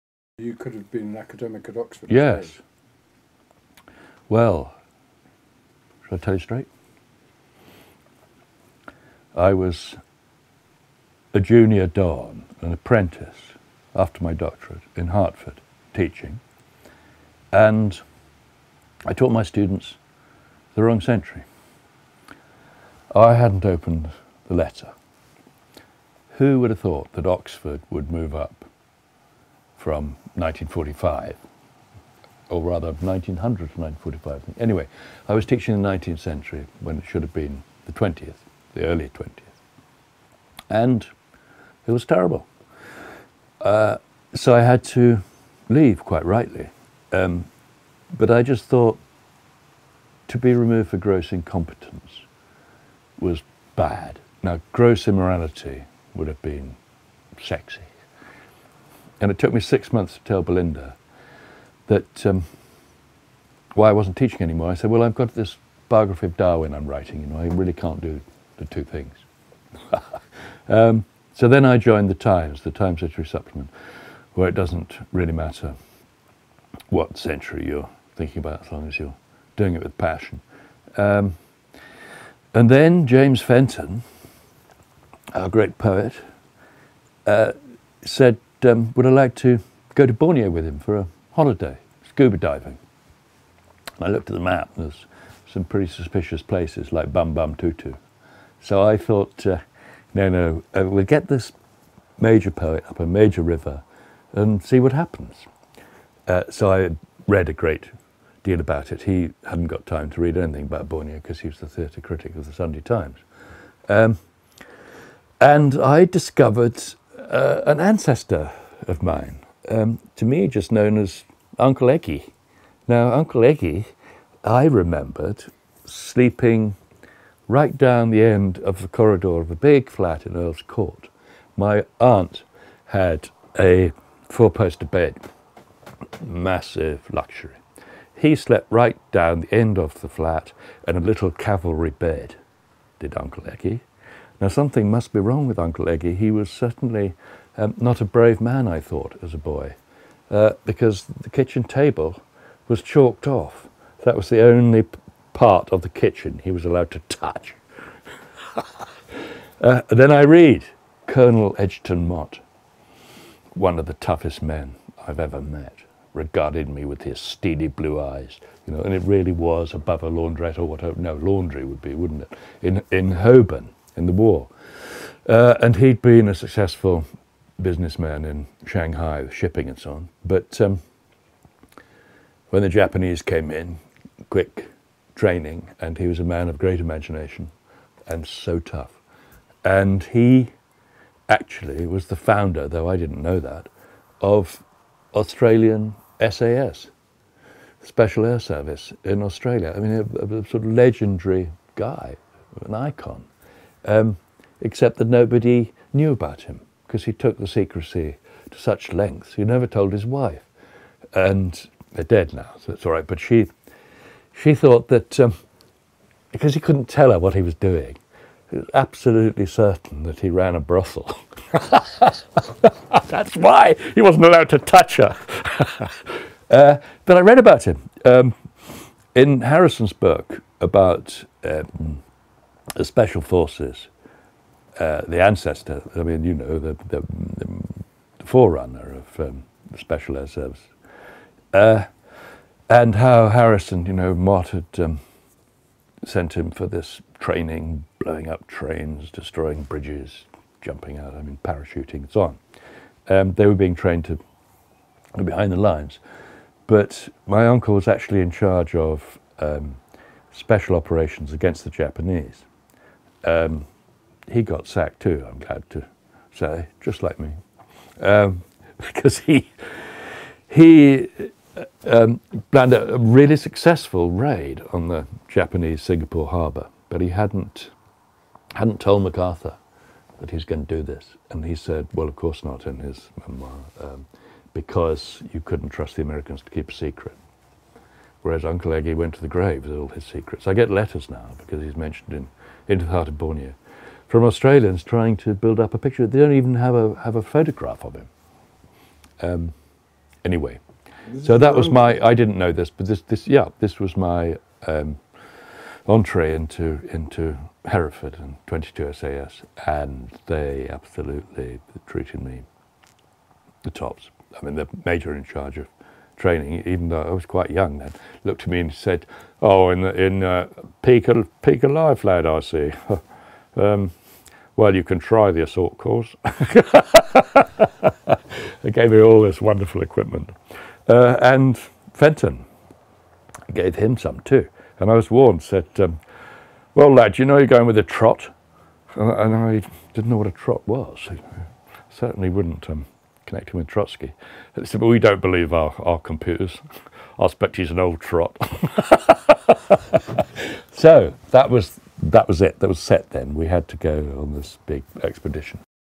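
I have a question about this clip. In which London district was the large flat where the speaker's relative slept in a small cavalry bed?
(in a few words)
Earl's Court.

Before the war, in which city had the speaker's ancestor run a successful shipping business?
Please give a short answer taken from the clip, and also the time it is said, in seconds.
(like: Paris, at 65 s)
Shanghai, at 178 s.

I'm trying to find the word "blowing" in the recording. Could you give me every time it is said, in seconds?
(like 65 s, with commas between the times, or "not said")
247 s.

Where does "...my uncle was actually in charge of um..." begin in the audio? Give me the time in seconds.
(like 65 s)
257 s.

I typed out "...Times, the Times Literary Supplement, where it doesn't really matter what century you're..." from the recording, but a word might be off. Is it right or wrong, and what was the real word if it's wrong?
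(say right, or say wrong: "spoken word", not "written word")
right.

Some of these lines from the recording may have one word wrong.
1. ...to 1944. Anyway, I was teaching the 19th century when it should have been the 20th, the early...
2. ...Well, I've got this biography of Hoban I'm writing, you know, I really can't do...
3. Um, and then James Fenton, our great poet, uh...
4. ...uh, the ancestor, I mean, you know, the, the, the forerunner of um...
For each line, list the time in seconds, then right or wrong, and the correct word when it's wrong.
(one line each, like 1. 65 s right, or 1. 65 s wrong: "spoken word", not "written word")
1. 33 s wrong: "1945", not "1944"
2. 64 s wrong: "Darwin", not "Hoban"
3. 80 s right
4. 234 s right.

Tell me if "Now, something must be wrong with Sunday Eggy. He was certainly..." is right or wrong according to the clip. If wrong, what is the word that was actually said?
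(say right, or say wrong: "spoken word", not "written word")
wrong: "Uncle", not "Sunday".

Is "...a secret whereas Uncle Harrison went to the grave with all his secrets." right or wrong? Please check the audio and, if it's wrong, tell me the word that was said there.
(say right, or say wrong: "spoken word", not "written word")
wrong: "Eggy", not "Harrison".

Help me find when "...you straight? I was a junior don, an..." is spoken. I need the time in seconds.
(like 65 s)
6 s.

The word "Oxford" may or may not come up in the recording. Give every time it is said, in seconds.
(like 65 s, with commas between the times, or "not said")
1 s, 27 s.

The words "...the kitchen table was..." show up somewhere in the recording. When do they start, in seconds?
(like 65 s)
151 s.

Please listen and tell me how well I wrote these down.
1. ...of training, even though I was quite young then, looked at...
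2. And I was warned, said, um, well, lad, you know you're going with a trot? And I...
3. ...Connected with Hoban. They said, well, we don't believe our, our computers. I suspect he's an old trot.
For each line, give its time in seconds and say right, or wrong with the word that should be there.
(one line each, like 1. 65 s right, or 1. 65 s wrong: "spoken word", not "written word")
1. 315 s right
2. 334 s right
3. 343 s wrong: "Trotsky", not "Hoban".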